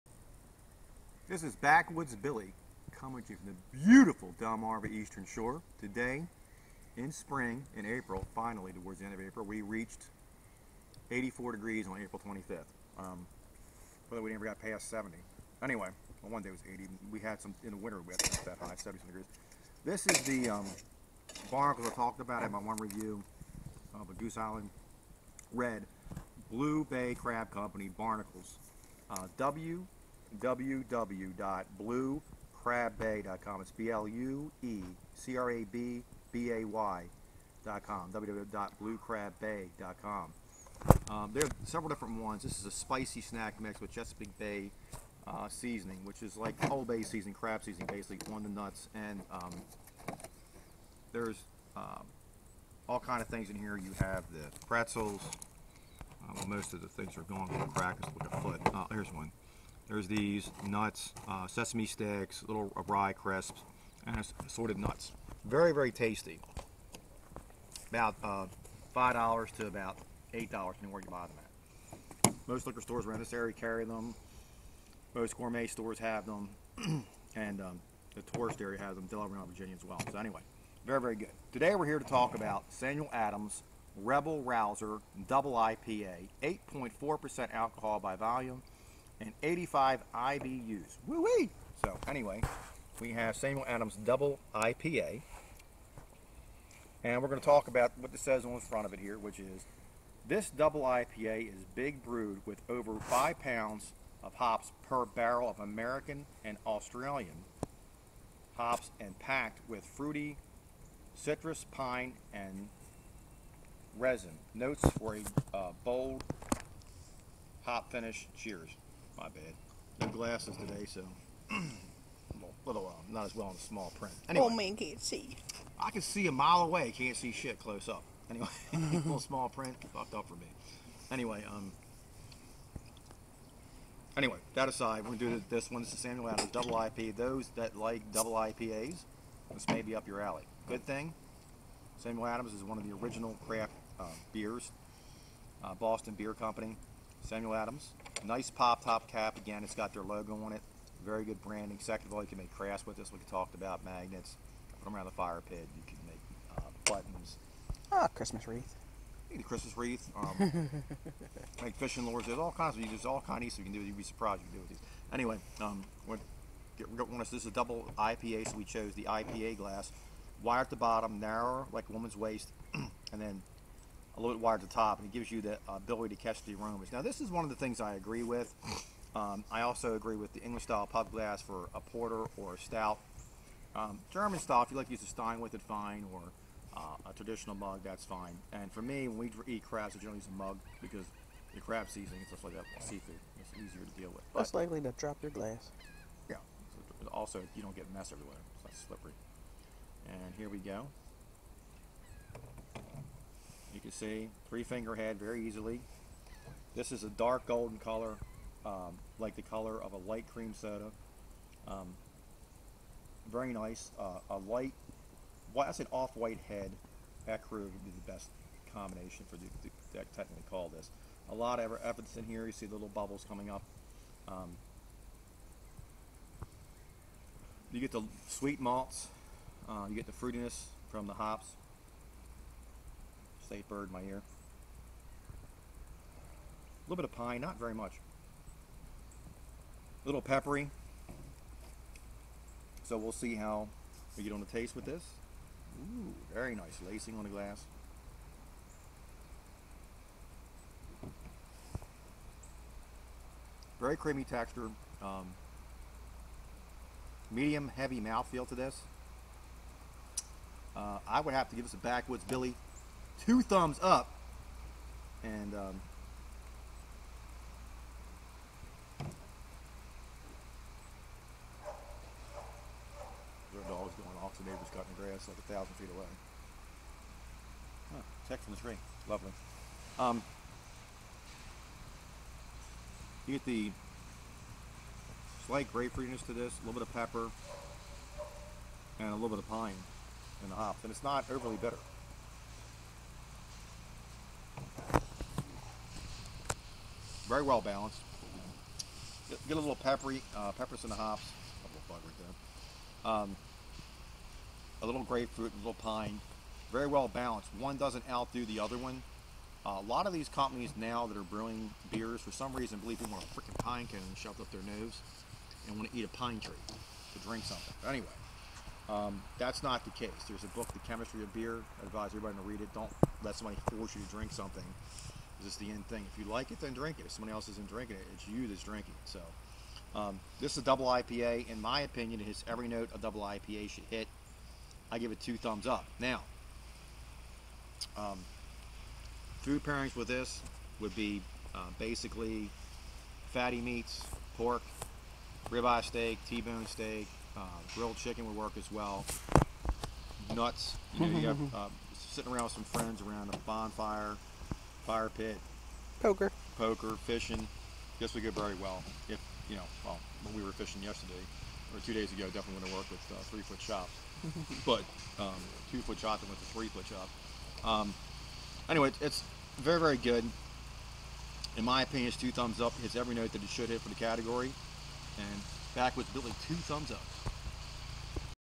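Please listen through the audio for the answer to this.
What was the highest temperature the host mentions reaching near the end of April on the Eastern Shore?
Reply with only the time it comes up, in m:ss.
0:11.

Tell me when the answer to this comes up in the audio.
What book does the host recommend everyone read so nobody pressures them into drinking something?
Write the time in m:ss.
5:20.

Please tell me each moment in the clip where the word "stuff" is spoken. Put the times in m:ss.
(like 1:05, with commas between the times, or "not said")
2:43, 3:12.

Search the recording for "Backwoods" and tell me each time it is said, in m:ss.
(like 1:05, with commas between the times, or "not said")
0:01, 4:21, 6:15.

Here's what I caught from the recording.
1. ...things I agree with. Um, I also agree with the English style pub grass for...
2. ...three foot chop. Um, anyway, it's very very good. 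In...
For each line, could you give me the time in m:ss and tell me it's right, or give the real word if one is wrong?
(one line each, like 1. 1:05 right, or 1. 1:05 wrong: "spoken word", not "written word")
1. 2:57 wrong: "glass", not "grass"
2. 6:06 right.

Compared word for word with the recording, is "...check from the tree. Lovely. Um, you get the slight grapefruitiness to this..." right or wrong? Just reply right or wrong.
right.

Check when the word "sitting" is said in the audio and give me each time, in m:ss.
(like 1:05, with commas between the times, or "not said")
5:52.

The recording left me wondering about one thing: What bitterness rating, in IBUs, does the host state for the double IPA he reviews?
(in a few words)
85.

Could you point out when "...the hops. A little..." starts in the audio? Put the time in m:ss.
5:00.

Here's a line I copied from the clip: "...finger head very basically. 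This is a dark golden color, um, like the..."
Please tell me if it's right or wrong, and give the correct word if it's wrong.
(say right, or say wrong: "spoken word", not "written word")
wrong: "easily", not "basically".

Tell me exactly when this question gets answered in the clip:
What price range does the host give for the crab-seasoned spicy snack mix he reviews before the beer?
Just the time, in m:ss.
1:08.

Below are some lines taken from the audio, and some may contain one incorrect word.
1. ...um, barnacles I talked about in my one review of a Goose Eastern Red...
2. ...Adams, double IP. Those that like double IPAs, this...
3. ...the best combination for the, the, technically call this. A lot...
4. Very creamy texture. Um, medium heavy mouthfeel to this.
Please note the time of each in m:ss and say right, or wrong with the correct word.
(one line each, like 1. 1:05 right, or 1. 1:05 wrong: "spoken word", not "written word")
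1. 0:20 wrong: "Island", not "Eastern"
2. 2:16 right
3. 3:37 right
4. 4:13 right.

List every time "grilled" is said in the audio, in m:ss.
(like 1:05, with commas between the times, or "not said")
5:47.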